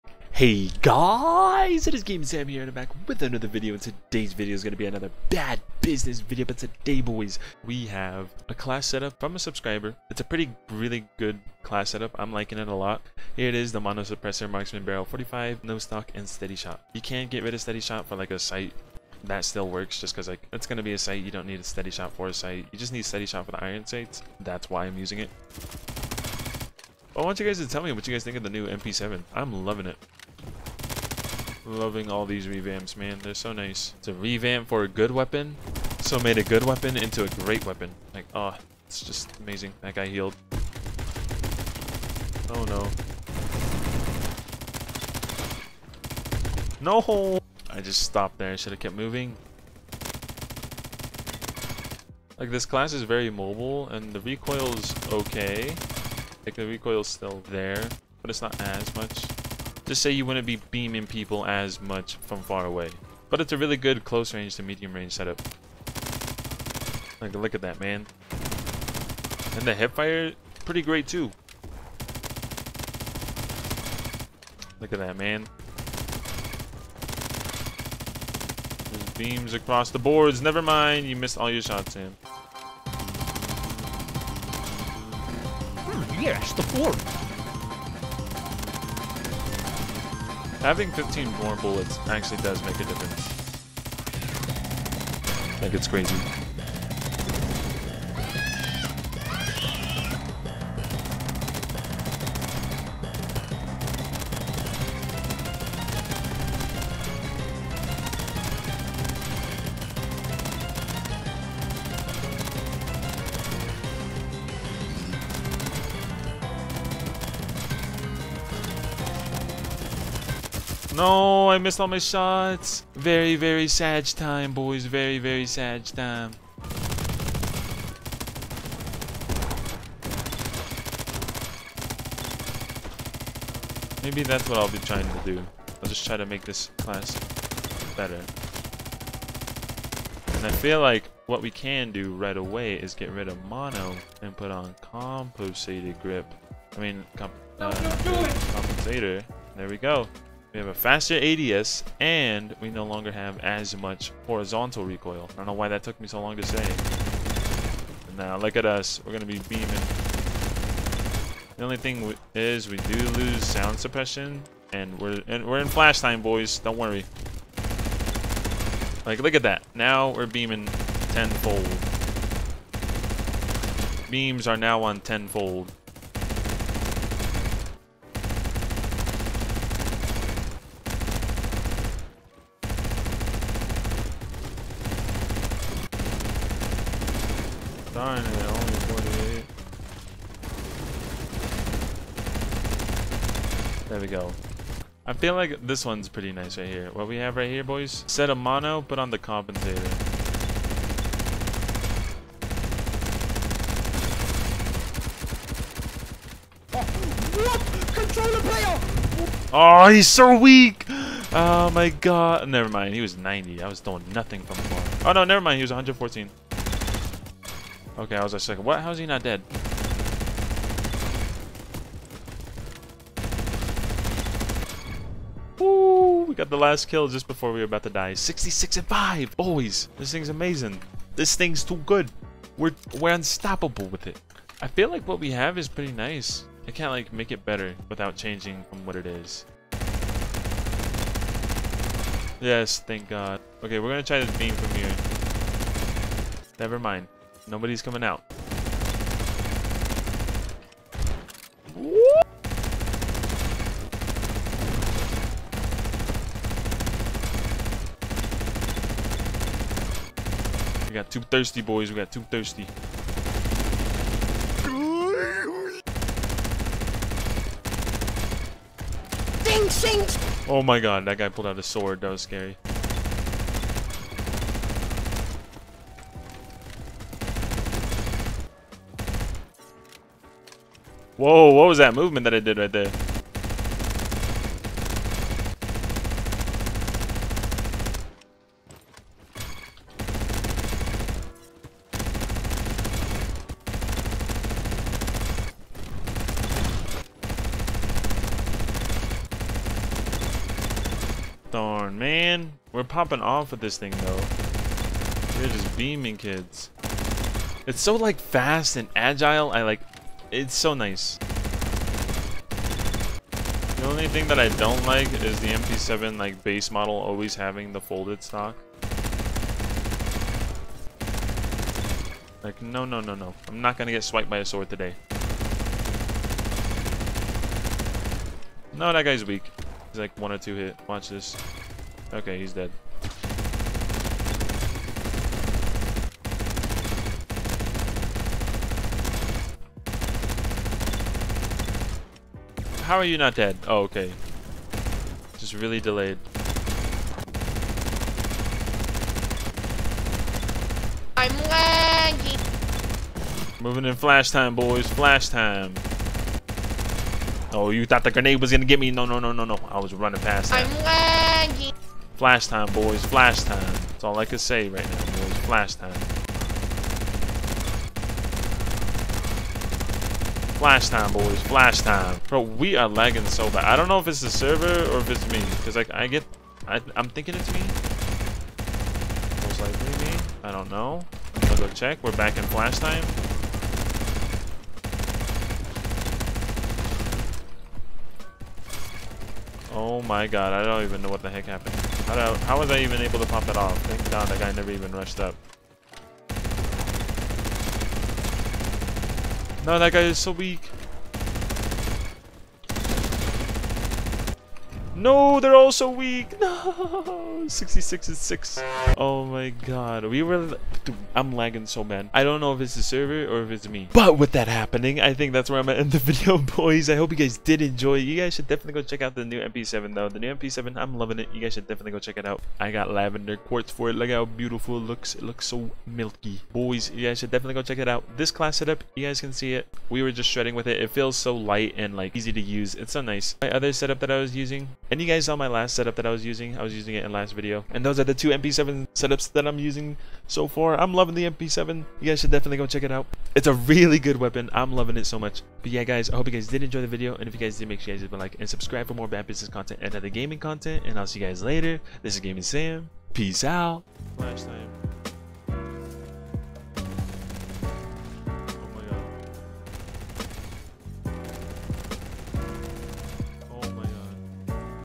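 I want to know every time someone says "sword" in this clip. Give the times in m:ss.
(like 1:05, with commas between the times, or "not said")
4:31, 5:24.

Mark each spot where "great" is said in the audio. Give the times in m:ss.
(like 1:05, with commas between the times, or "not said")
0:37, 1:10.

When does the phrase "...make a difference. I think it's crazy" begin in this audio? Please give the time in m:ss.
1:32.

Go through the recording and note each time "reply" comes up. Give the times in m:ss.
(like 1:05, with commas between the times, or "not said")
not said.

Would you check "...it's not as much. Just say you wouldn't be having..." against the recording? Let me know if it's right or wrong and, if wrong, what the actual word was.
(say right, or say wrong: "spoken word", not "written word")
wrong: "beaming", not "having".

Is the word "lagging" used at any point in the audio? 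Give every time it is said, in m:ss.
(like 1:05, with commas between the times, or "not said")
5:51, 6:01, 6:12, 6:51.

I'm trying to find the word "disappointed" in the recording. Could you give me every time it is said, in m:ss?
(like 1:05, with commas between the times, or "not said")
not said.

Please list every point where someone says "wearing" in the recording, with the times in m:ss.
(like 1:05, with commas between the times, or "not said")
not said.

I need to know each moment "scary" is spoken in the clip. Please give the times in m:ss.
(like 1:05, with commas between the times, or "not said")
4:32.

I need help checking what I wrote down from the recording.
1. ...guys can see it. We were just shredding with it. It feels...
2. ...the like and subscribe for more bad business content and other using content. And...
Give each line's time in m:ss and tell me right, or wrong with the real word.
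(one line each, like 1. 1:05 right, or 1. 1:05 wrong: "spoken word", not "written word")
1. 7:09 right
2. 7:28 wrong: "gaming", not "using".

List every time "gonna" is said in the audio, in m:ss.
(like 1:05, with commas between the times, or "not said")
4:03, 5:23, 5:58.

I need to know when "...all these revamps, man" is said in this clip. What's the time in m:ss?
0:32.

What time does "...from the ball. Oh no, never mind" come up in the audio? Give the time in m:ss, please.
3:34.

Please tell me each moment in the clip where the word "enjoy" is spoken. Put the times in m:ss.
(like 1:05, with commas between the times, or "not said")
6:57, 7:26.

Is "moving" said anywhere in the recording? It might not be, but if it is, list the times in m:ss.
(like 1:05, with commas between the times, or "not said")
0:48, 5:53.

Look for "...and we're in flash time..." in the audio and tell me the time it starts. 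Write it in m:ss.
2:45.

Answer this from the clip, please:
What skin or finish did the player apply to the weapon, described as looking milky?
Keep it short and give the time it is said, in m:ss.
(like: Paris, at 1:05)
Lavender quartz, at 7:02.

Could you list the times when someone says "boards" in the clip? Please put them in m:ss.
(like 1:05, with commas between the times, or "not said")
1:19, 1:26.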